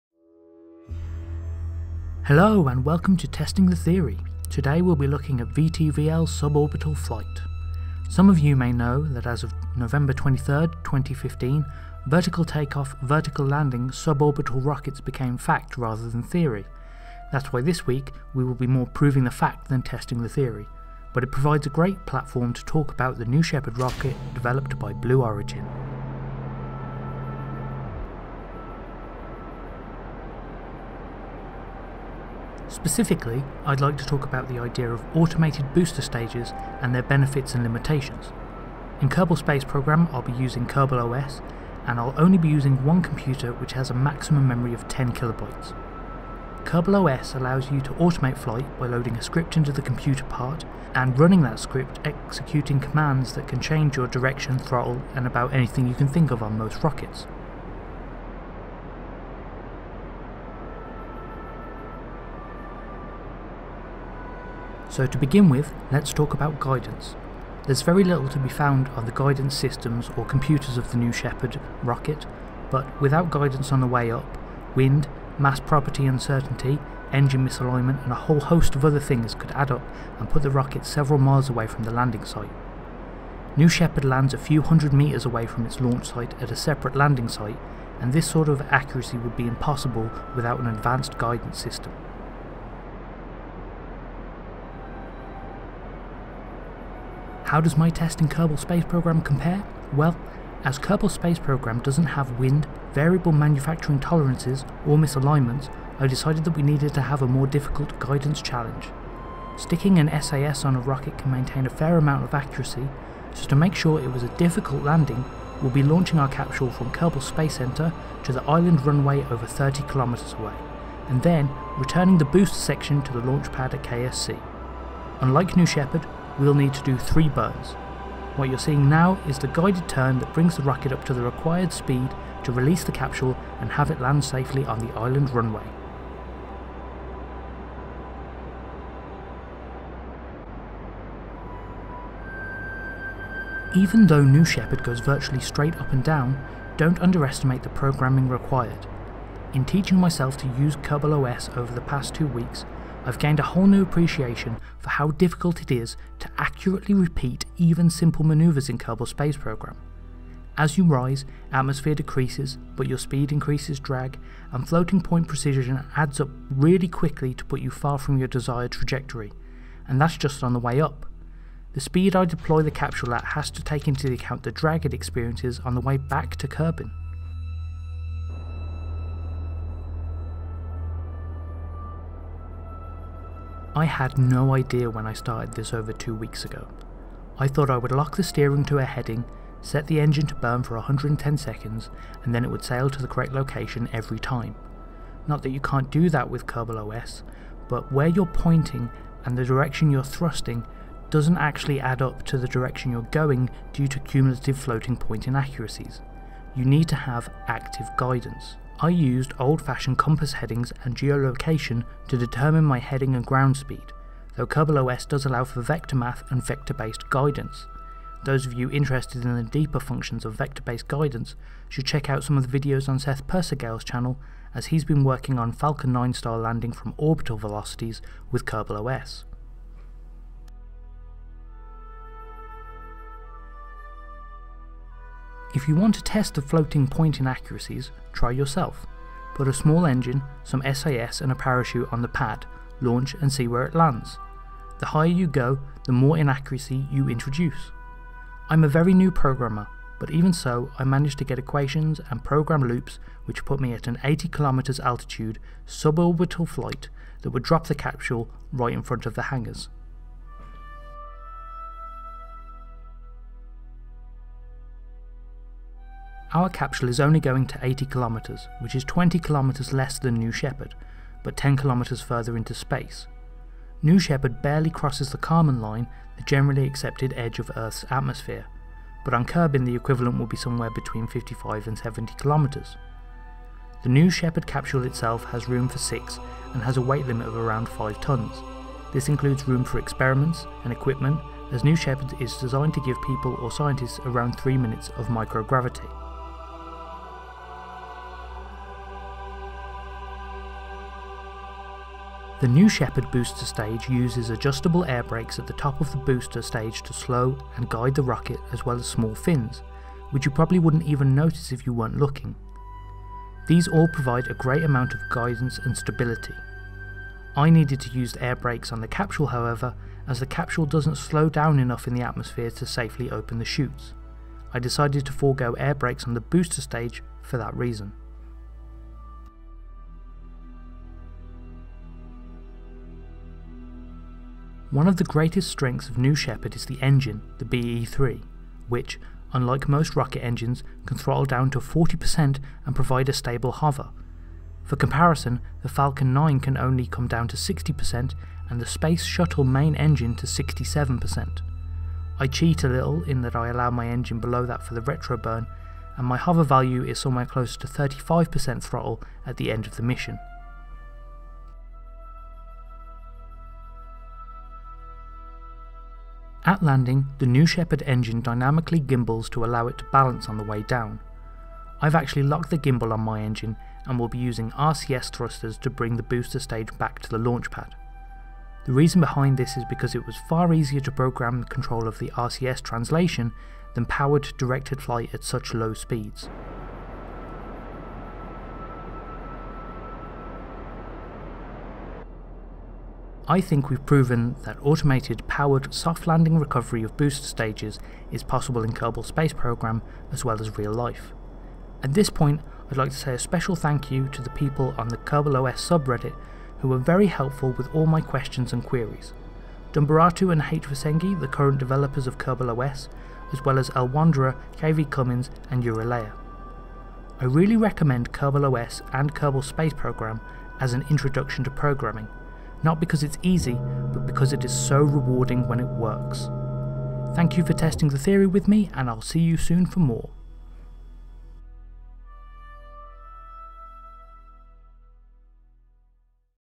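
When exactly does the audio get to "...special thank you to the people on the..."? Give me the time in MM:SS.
06:43.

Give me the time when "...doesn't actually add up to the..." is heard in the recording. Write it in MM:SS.
03:21.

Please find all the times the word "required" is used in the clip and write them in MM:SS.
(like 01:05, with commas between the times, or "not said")
02:11, 02:28.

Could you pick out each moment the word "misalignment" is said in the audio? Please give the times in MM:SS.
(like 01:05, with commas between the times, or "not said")
01:17, 01:44.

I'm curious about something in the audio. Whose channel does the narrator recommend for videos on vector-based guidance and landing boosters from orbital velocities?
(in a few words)
Seth Persigehl.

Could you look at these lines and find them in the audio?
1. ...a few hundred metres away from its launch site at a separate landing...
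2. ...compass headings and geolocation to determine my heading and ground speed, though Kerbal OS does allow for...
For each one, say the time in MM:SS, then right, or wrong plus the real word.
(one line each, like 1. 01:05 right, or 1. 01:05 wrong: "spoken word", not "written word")
1. 01:24 right
2. 03:29 right.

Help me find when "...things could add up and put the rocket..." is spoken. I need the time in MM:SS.
01:18.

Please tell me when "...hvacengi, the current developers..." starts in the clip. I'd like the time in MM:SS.
06:50.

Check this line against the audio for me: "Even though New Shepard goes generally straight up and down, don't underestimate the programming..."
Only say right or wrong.
wrong.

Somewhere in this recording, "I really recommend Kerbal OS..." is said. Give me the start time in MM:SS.
06:57.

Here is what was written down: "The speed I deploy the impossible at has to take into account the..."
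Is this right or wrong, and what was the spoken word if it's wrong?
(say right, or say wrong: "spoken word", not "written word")
wrong: "capsule", not "impossible".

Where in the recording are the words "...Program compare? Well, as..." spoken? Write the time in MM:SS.
01:38.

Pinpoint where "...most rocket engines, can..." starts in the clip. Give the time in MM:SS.
05:39.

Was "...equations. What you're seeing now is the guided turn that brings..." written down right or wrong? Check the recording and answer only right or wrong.
wrong.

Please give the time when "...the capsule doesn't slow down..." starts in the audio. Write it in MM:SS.
05:20.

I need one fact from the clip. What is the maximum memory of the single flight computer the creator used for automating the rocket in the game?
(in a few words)
10 kilobytes.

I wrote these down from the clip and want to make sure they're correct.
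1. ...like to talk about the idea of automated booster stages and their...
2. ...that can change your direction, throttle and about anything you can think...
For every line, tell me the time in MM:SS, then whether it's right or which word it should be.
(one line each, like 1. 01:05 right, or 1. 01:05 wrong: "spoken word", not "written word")
1. 00:33 right
2. 00:53 right.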